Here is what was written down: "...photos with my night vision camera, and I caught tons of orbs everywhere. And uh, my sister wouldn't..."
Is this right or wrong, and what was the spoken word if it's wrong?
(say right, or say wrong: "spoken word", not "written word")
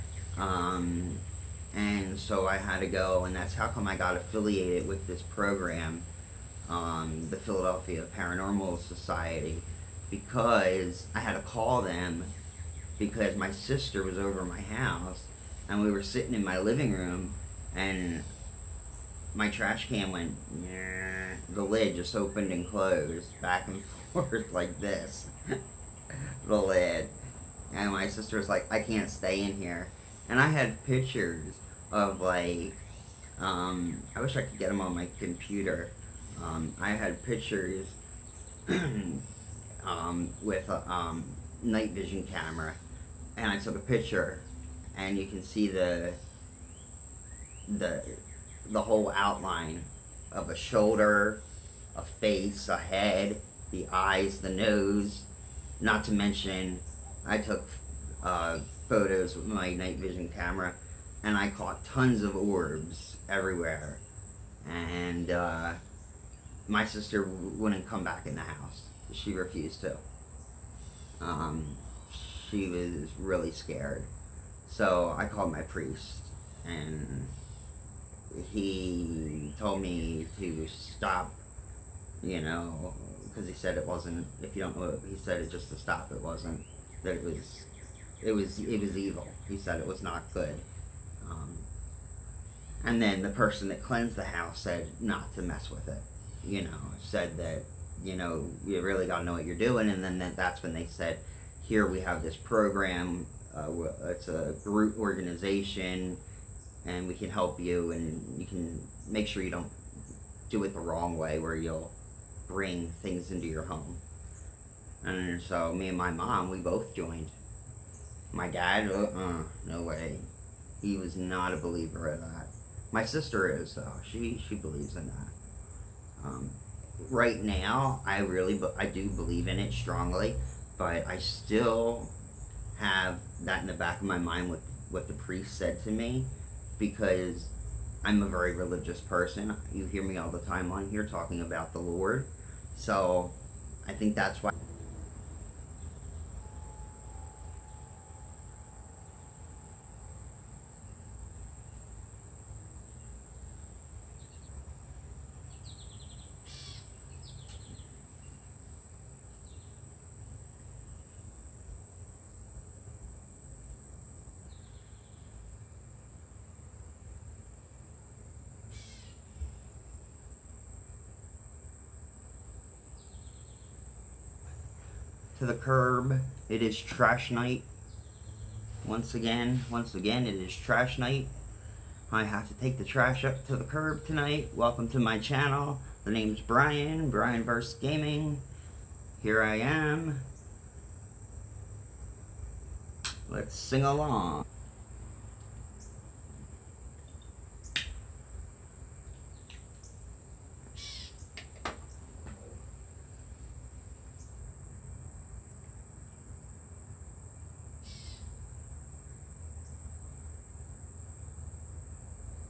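right.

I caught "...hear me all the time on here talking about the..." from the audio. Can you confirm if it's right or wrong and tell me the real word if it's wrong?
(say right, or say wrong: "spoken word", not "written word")
right.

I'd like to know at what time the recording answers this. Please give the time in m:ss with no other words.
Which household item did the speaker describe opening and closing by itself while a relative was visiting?
0:19.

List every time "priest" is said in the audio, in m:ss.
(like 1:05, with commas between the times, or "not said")
1:15, 2:15.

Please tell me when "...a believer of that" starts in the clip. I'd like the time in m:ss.
2:01.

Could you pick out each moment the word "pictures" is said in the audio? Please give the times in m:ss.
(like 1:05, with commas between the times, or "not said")
0:30, 0:37, 0:43.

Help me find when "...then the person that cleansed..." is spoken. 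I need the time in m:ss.
1:33.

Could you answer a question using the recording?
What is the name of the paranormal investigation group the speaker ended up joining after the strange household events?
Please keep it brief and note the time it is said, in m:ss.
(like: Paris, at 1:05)
Philadelphia Paranormal Society, at 0:07.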